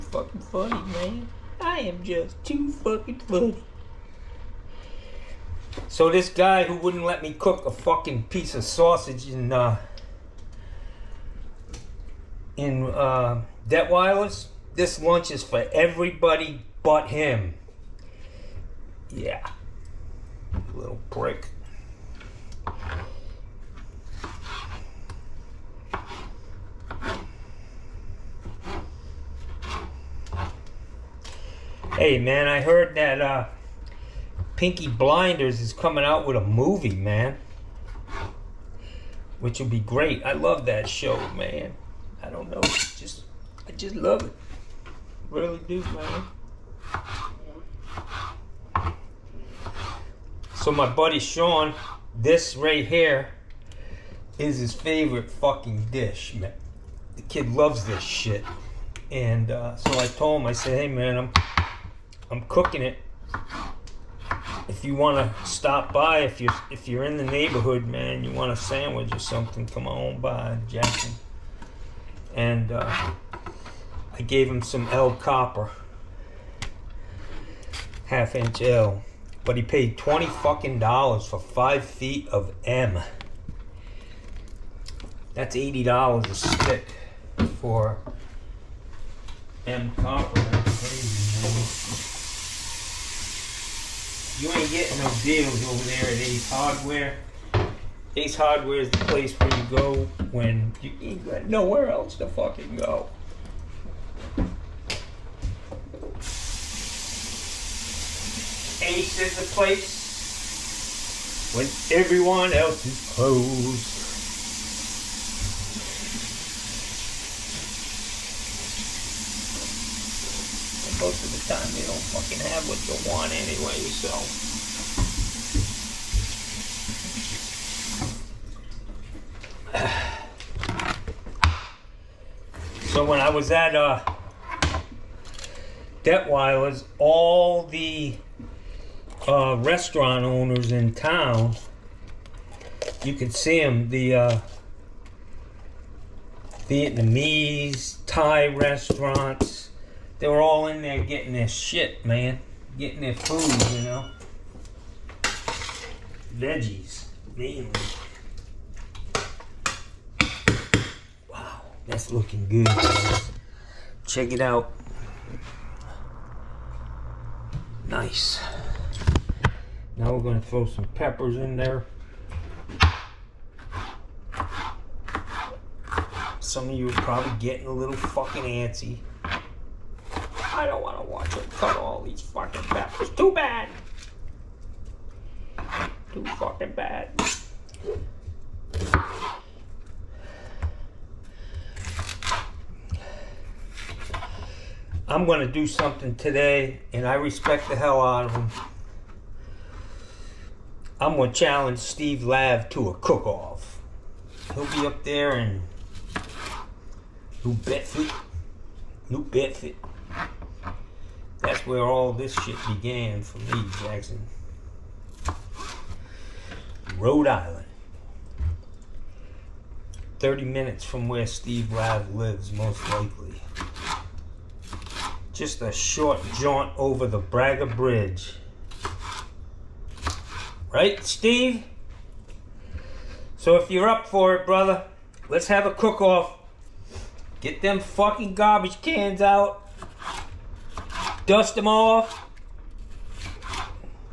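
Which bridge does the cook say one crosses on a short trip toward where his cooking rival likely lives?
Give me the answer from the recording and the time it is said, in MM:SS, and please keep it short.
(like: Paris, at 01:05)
Braga Bridge, at 03:47.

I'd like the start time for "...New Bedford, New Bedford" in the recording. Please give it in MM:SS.
03:27.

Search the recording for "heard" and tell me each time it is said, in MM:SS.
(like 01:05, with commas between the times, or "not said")
00:32.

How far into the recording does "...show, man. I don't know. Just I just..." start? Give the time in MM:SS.
00:40.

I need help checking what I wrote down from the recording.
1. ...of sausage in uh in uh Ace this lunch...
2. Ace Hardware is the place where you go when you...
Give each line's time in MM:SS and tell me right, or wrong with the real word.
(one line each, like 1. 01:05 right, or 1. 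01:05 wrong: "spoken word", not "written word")
1. 00:08 wrong: "Debt", not "Ace"
2. 01:38 right.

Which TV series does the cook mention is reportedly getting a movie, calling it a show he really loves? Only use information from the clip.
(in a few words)
Peaky Blinders.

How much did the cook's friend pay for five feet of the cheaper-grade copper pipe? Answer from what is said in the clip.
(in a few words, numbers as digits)
$20.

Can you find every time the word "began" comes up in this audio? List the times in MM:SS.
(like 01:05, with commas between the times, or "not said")
03:32.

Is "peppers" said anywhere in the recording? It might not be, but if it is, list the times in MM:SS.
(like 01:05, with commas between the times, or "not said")
02:50, 03:02.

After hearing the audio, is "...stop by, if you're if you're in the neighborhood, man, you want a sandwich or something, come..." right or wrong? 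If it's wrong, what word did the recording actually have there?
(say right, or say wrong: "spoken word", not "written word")
right.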